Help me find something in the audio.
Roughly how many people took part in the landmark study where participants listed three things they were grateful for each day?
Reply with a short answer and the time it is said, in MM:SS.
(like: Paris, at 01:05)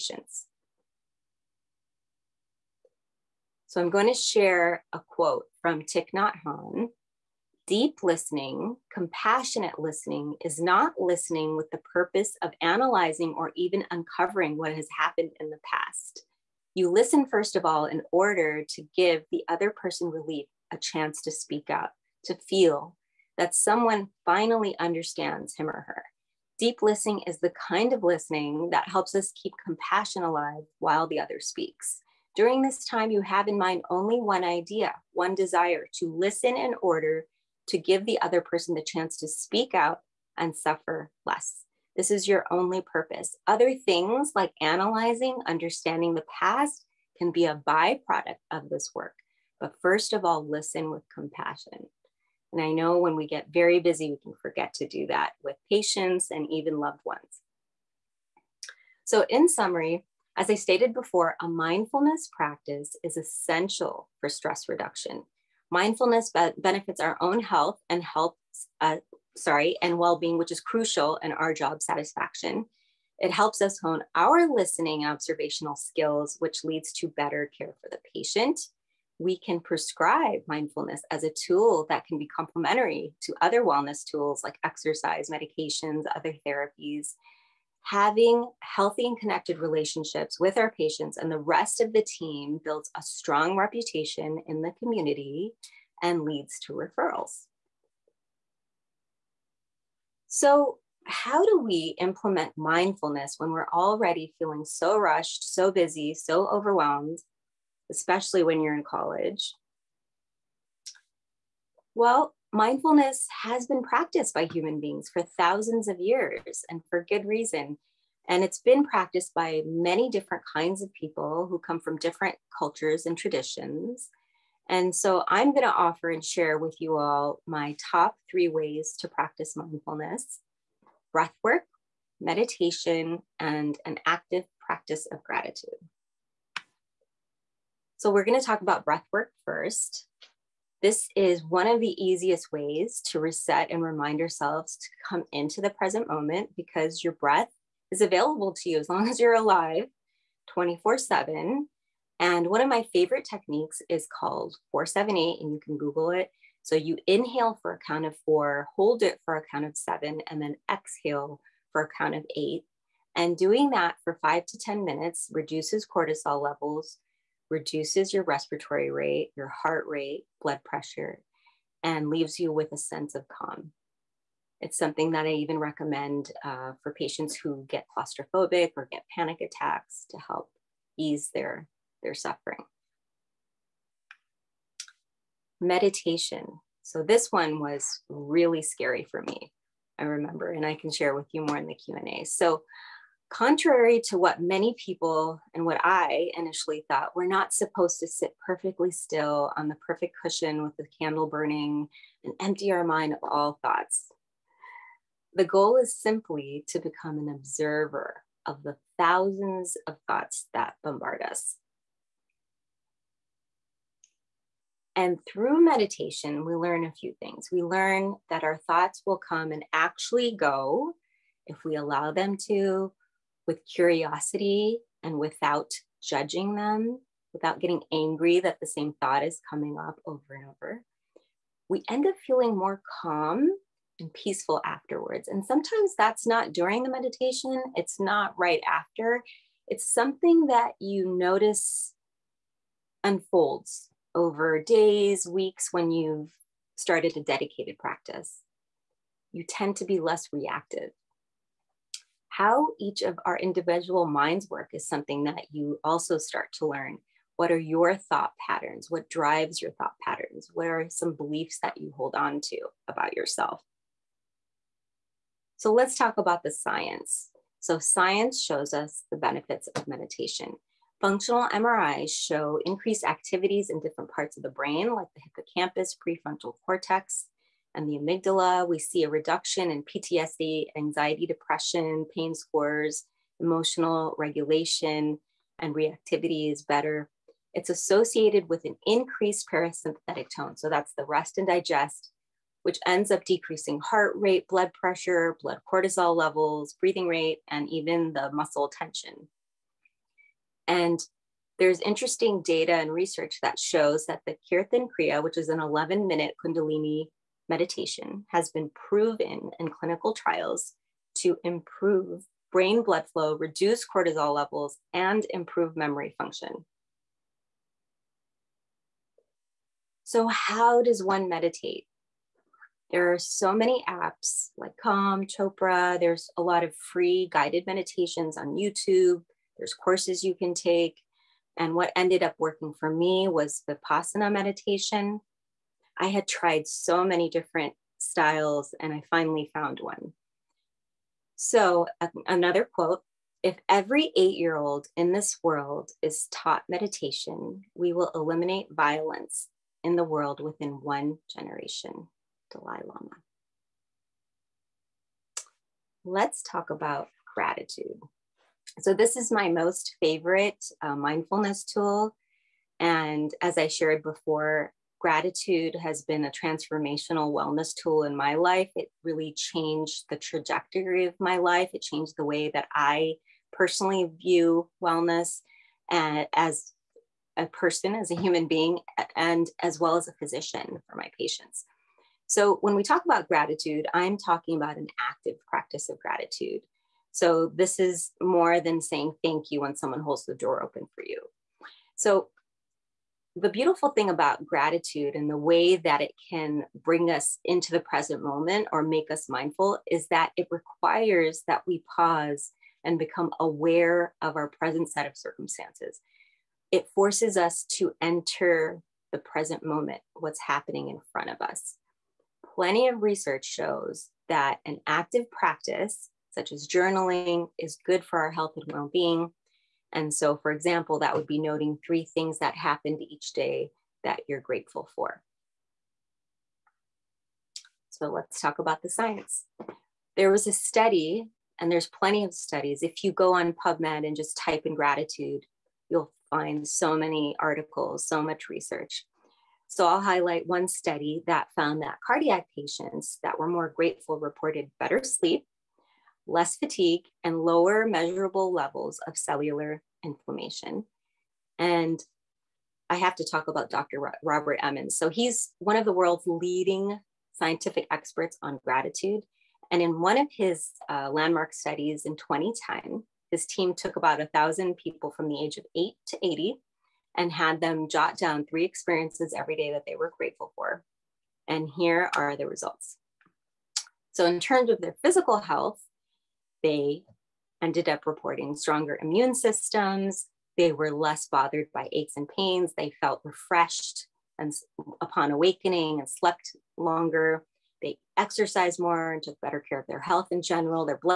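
1,000, at 07:44.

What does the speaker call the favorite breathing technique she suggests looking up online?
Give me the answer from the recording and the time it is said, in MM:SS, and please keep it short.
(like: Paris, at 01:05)
478, at 02:34.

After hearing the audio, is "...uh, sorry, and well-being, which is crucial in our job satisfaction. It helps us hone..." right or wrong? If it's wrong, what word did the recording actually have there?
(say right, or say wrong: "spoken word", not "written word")
right.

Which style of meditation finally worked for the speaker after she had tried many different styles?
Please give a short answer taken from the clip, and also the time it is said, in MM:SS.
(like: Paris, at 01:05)
Vipassana, at 05:33.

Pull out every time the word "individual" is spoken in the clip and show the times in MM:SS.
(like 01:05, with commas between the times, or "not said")
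04:13.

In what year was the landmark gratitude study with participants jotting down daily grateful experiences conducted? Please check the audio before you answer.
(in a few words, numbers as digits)
2010.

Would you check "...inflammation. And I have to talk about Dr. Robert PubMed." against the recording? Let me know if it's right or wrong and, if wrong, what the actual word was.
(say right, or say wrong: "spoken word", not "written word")
wrong: "Emmons", not "PubMed".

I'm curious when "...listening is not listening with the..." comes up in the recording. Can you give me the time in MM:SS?
00:09.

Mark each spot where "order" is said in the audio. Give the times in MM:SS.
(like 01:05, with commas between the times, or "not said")
00:18, 00:36.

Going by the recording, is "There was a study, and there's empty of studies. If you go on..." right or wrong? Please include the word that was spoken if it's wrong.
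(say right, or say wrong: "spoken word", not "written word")
wrong: "plenty", not "empty".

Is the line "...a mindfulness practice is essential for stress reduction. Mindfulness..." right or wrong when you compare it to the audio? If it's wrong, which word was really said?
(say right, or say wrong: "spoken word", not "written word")
right.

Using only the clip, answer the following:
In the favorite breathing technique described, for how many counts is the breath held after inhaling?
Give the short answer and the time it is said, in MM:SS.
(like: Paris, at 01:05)
7, at 02:39.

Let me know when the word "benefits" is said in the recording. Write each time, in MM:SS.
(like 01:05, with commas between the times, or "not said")
01:06, 04:29.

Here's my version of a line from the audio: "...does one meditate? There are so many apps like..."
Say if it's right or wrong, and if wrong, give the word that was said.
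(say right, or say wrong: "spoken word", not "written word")
right.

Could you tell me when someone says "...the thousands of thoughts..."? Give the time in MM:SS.
03:28.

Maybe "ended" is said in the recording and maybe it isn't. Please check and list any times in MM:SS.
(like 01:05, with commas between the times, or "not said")
05:31, 07:57.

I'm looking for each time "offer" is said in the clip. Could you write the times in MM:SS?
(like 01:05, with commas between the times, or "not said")
02:05.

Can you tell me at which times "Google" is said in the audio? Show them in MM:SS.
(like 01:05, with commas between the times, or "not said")
02:35.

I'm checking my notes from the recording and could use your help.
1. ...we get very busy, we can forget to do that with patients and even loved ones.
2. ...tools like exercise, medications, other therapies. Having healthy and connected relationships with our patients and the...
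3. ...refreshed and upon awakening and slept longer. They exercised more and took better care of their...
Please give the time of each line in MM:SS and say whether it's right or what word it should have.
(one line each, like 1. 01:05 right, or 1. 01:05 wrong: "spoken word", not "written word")
1. 00:53 right
2. 01:24 right
3. 08:03 right.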